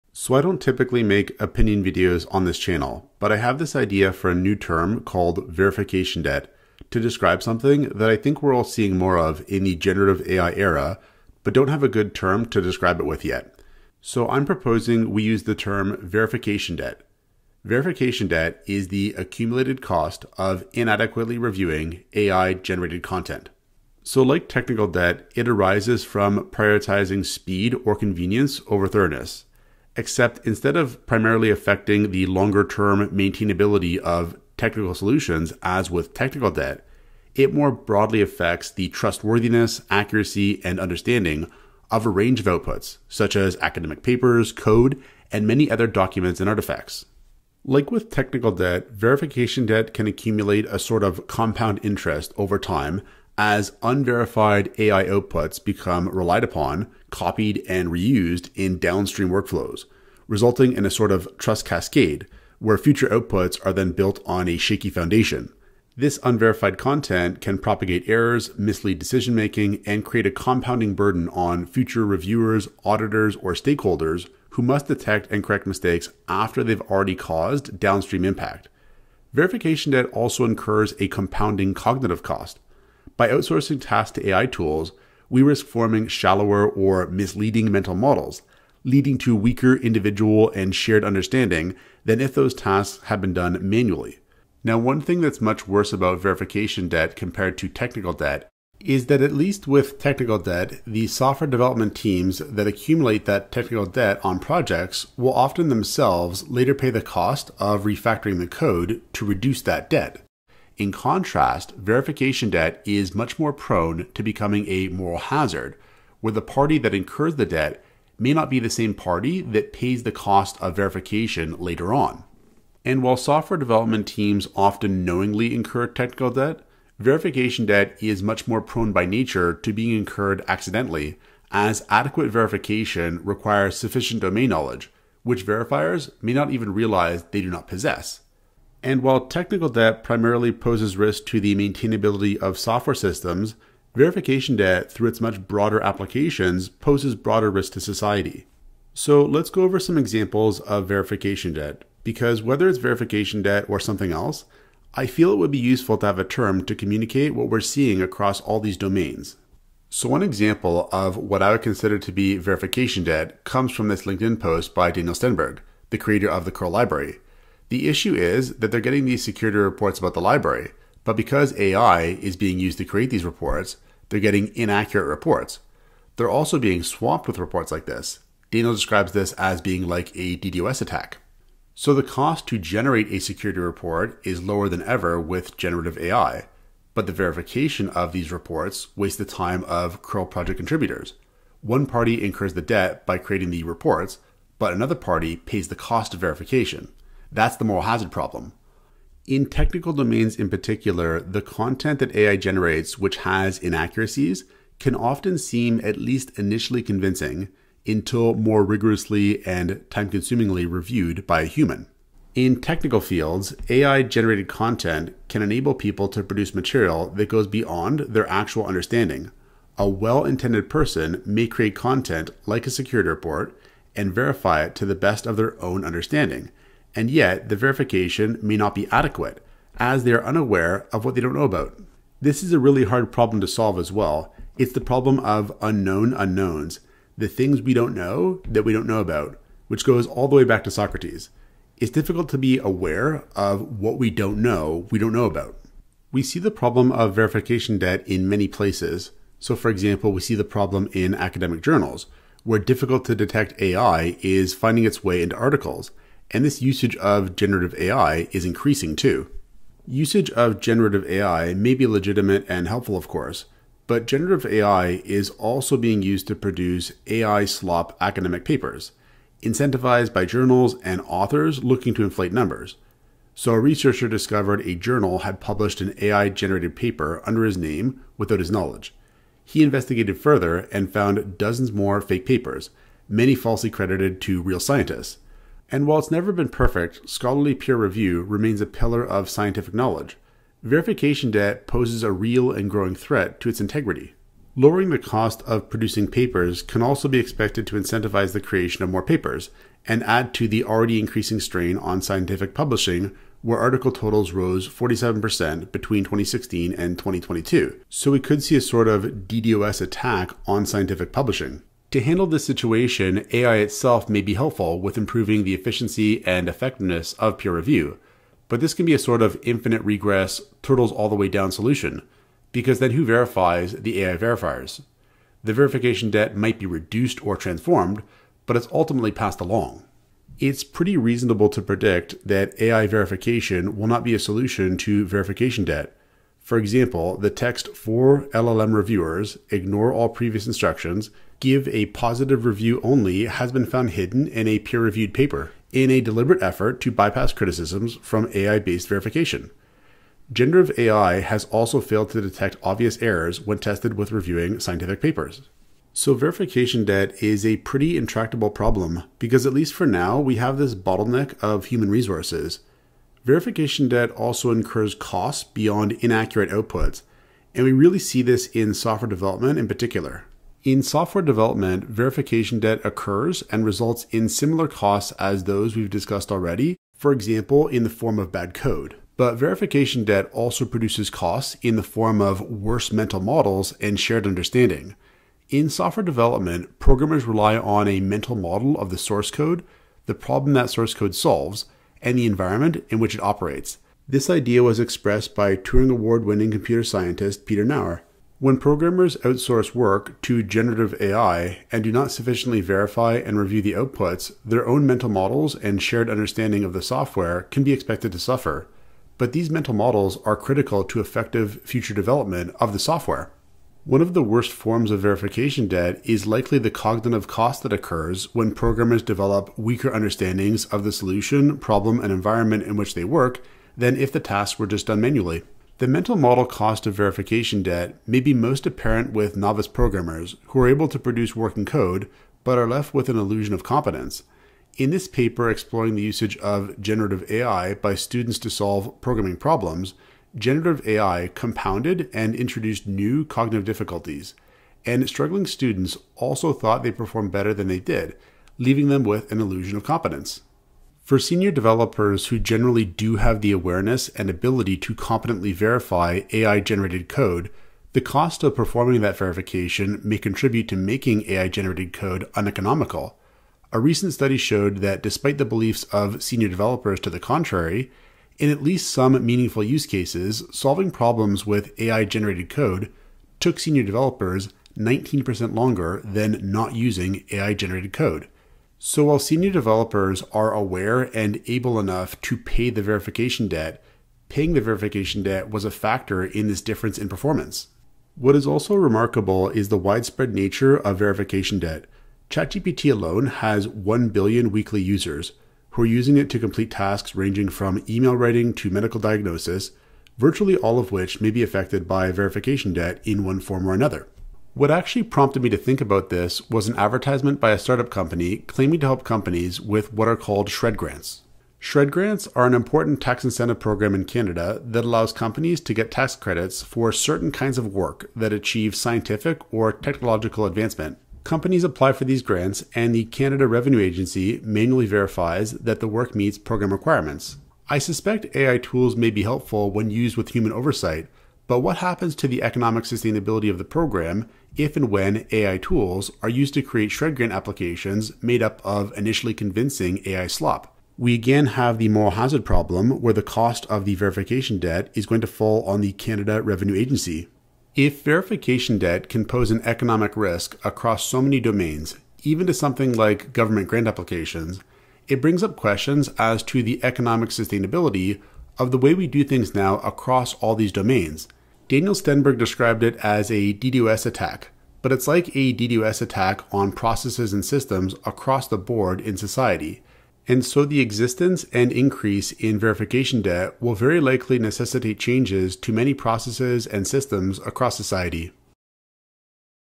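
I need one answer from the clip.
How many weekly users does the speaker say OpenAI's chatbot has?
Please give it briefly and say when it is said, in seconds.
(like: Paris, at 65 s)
1 billion, at 493 s.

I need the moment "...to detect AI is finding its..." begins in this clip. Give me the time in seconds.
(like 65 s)
253 s.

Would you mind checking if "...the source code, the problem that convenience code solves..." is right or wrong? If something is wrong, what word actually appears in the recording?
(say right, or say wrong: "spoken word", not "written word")
wrong: "source", not "convenience".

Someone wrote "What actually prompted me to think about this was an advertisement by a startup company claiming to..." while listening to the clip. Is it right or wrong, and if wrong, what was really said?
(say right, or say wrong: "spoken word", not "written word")
right.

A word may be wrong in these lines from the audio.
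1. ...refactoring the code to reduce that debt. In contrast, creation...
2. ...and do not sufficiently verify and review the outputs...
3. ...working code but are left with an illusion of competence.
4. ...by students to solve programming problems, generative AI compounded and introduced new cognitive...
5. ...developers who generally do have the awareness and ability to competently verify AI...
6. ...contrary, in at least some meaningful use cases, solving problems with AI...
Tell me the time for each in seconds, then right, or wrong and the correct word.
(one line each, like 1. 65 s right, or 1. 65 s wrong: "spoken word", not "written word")
1. 107 s wrong: "verification", not "creation"
2. 401 s right
3. 431 s right
4. 437 s right
5. 451 s right
6. 467 s right.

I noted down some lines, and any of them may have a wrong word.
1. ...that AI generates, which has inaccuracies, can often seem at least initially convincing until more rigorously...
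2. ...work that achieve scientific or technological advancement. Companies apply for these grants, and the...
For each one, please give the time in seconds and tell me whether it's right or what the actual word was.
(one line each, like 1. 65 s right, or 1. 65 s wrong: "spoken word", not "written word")
1. 201 s right
2. 517 s right.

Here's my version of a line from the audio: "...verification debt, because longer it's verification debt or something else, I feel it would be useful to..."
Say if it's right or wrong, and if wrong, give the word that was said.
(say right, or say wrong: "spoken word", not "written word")
wrong: "whether", not "longer".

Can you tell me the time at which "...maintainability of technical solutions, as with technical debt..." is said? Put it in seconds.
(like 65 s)
33 s.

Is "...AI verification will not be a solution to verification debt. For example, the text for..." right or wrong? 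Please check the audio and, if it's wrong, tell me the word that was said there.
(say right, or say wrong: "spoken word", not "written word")
right.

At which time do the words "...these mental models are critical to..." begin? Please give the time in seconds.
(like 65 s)
409 s.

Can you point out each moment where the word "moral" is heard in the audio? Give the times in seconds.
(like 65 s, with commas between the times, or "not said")
114 s, 197 s, 541 s.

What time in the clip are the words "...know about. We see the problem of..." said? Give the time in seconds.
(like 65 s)
245 s.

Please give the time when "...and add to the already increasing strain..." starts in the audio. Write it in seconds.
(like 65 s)
299 s.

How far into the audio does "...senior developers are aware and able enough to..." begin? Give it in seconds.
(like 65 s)
479 s.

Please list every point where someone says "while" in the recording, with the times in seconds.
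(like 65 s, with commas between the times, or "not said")
123 s, 139 s, 285 s, 479 s.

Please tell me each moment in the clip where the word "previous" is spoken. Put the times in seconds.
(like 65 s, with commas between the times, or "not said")
340 s.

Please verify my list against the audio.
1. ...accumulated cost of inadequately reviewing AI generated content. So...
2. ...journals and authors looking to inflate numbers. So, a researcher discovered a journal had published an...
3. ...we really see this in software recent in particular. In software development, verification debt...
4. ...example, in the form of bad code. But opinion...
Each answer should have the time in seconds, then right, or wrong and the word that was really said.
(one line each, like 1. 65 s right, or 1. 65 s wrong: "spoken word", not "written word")
1. 19 s right
2. 270 s right
3. 367 s wrong: "development", not "recent"
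4. 377 s wrong: "verification", not "opinion".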